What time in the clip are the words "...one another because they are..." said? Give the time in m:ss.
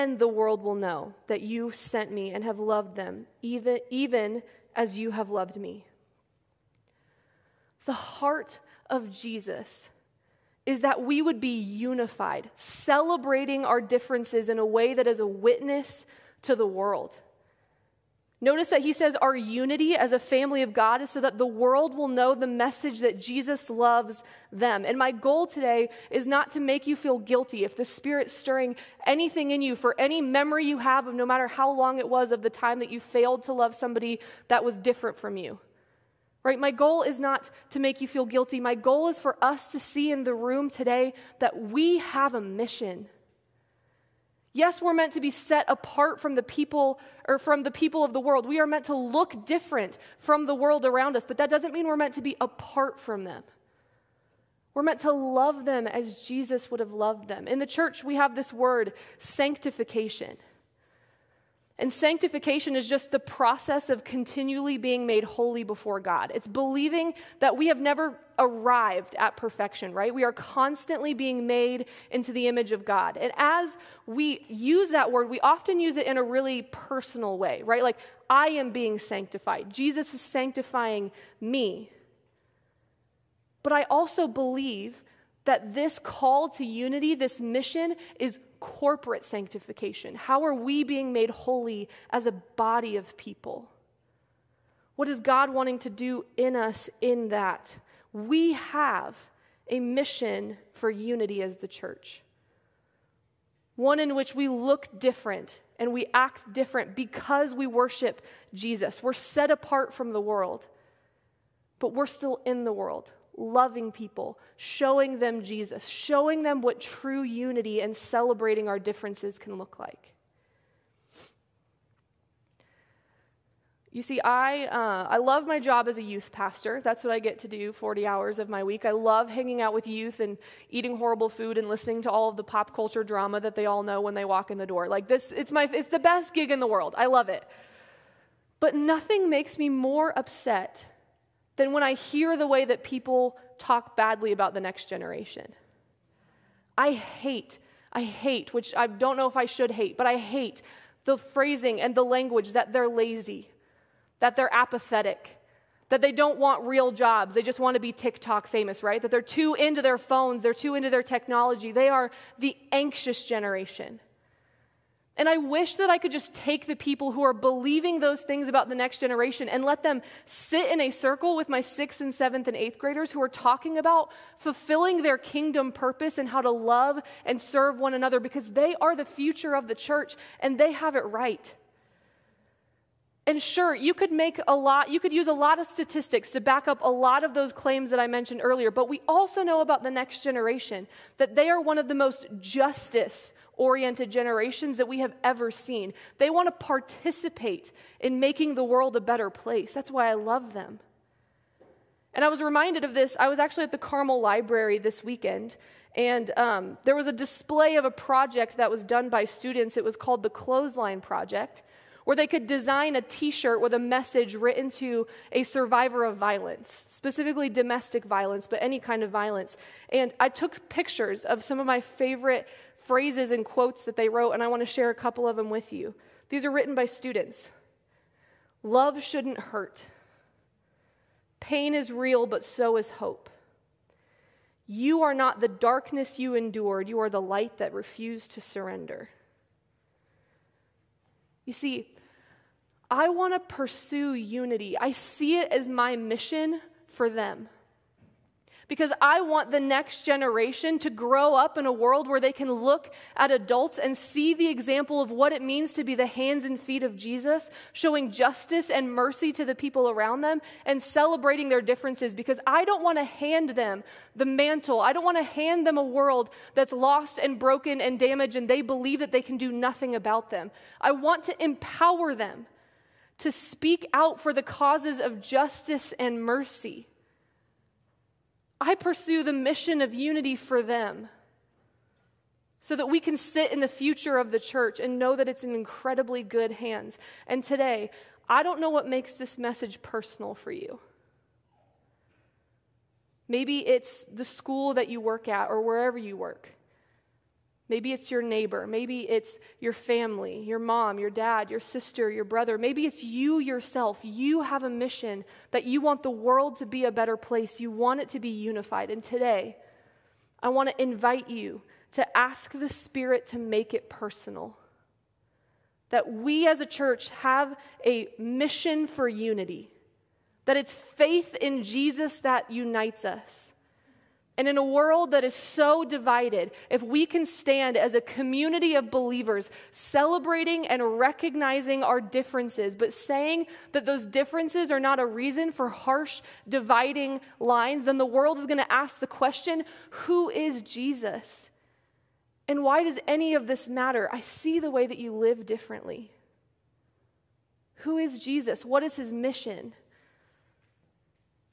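2:57.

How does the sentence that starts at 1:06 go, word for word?
It's believing that we have never arrived at perfection, right?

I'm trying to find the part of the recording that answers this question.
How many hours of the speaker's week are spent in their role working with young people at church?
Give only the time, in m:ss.
2:07.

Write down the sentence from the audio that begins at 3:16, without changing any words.
They want to participate in making the world a better place.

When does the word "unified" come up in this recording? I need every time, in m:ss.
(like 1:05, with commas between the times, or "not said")
0:11, 5:08.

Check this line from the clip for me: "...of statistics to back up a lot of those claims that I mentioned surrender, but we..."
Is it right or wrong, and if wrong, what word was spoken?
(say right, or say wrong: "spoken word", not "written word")
wrong: "earlier", not "surrender".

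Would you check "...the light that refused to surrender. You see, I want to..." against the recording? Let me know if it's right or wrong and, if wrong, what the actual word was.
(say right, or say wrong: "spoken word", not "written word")
right.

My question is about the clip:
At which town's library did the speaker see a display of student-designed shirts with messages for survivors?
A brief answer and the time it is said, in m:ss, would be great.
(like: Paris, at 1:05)
Carmel, at 3:23.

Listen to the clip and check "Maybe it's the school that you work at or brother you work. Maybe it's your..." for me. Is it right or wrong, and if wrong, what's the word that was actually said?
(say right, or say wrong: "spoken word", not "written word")
wrong: "wherever", not "brother".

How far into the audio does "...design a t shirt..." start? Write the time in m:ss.
3:32.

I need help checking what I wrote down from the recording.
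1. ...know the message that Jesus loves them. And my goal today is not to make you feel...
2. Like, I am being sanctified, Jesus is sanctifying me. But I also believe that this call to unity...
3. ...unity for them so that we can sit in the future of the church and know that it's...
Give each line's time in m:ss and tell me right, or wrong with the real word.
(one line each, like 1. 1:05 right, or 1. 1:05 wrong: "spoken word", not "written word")
1. 0:22 right
2. 1:17 right
3. 4:39 right.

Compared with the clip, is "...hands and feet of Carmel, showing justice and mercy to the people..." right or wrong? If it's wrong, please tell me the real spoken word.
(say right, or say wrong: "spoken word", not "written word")
wrong: "Jesus", not "Carmel".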